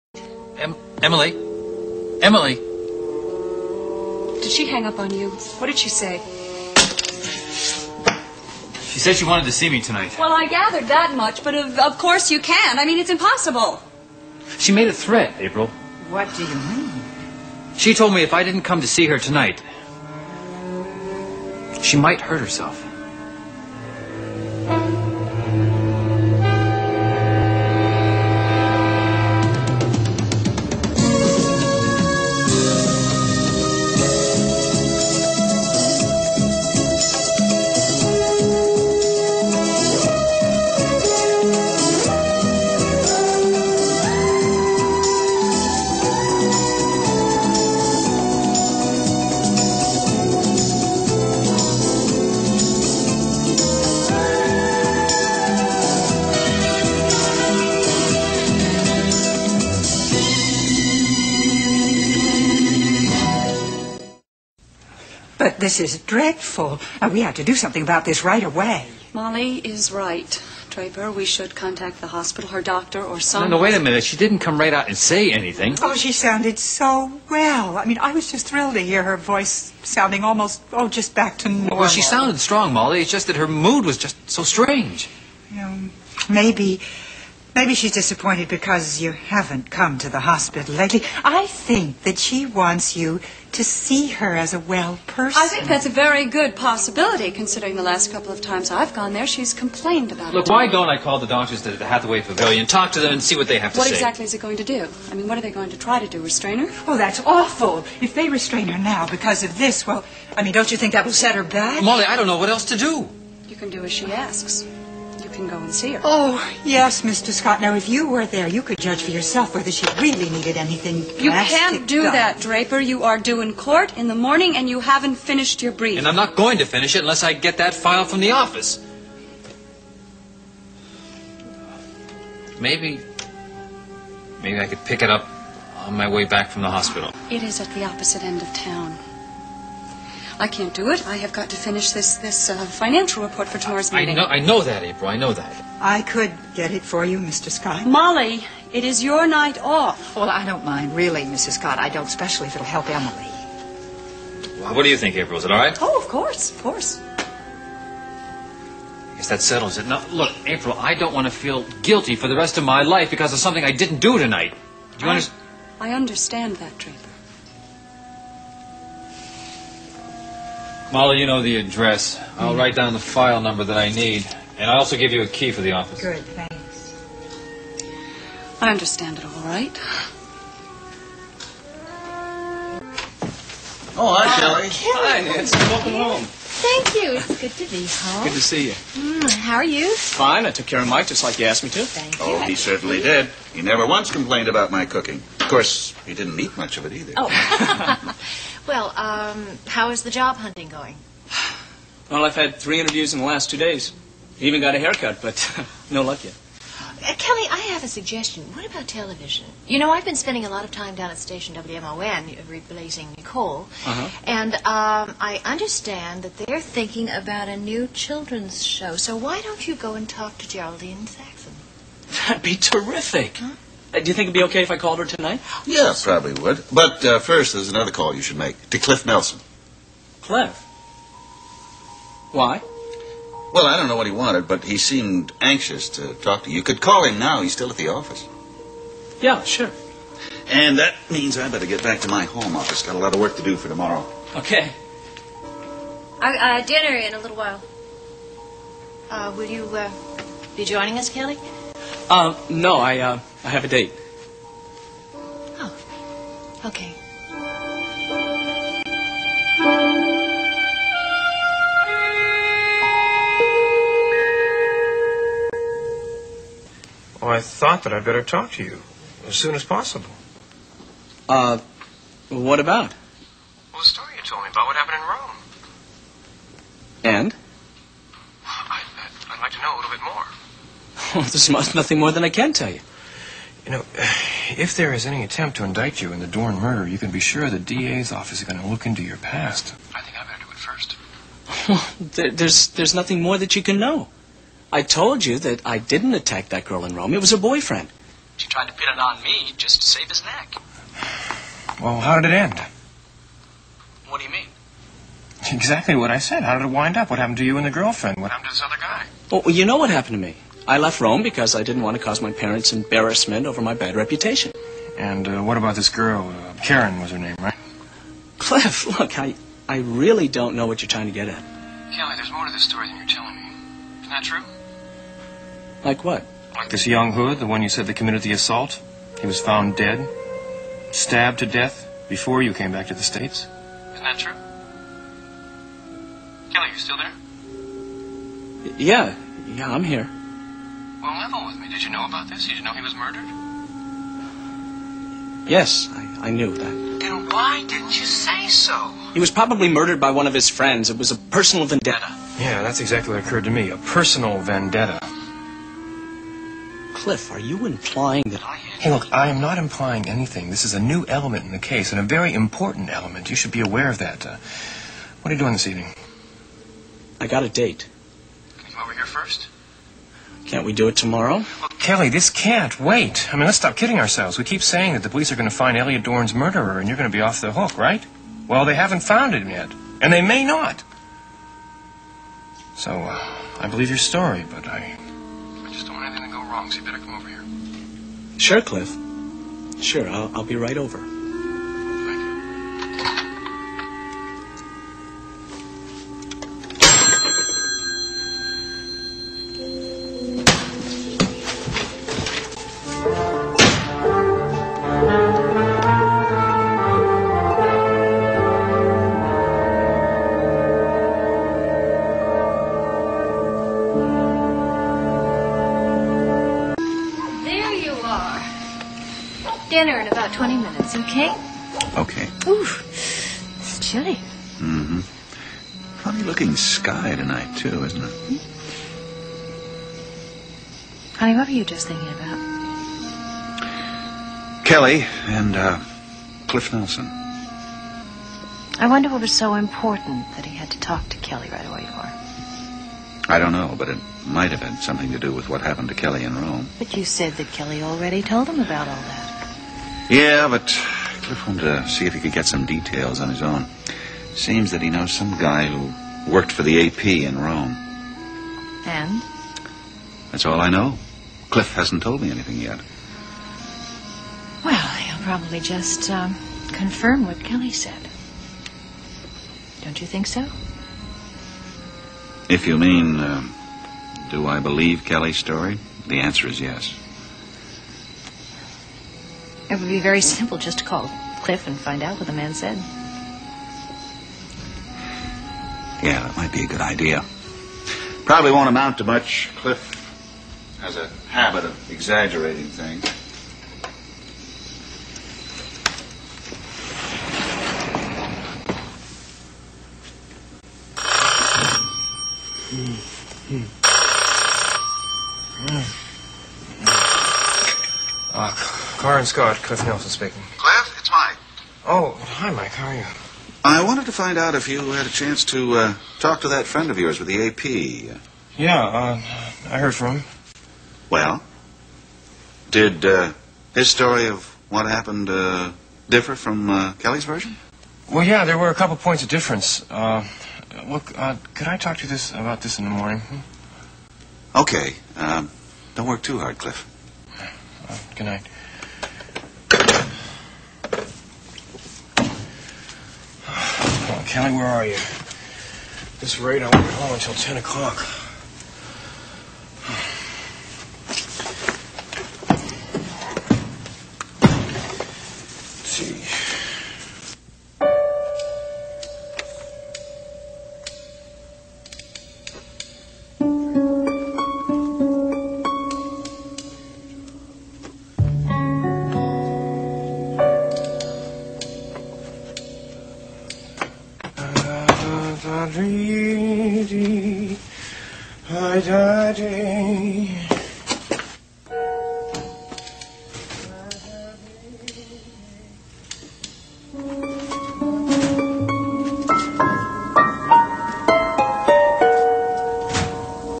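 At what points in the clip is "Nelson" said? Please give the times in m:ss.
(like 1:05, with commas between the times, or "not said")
3:49, 7:16, 8:29.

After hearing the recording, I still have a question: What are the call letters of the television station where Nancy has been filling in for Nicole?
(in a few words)
WMON.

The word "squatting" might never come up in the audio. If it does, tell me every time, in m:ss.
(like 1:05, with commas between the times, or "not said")
not said.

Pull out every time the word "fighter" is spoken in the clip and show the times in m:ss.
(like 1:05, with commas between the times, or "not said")
not said.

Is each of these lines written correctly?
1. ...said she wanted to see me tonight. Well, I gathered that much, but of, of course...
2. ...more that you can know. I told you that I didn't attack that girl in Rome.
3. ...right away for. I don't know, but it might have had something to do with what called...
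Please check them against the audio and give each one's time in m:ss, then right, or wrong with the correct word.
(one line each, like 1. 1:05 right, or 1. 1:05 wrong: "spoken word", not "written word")
1. 0:08 right
2. 4:53 right
3. 7:21 wrong: "happened", not "called".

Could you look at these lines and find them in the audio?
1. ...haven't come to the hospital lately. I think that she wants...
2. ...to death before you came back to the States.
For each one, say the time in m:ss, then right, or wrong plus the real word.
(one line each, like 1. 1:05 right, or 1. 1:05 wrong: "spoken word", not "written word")
1. 1:29 right
2. 5:31 right.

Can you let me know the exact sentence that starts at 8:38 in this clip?
Yeah, uh, I heard from him.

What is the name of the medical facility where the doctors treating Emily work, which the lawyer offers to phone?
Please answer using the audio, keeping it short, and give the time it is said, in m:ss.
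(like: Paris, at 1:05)
Hathaway Pavilion, at 1:41.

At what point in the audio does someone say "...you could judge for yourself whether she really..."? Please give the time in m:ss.
1:58.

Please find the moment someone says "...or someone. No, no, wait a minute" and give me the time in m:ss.
1:13.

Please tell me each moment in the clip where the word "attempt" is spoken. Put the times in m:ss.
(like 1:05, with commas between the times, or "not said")
4:45.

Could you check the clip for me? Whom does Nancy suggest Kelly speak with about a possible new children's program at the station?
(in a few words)
Geraldine Saxon.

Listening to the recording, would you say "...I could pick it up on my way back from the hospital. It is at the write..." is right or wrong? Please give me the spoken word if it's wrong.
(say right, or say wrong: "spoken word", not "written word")
wrong: "opposite", not "write".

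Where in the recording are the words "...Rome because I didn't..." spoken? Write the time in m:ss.
5:11.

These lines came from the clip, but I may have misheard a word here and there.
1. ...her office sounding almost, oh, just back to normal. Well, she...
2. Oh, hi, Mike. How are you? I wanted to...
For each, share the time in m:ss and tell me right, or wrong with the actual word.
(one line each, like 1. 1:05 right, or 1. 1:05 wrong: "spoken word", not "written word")
1. 1:19 wrong: "voice", not "office"
2. 8:31 right.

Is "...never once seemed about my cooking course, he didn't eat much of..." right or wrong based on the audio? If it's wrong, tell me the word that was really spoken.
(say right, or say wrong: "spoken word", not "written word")
wrong: "complained", not "seemed".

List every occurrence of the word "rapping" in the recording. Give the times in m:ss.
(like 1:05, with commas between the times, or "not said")
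not said.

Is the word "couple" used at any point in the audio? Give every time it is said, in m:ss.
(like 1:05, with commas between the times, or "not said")
1:38, 8:48.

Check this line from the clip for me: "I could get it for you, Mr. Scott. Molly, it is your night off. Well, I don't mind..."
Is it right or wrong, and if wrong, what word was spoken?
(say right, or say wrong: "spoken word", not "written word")
right.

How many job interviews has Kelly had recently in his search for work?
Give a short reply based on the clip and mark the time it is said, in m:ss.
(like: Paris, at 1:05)
3, at 3:22.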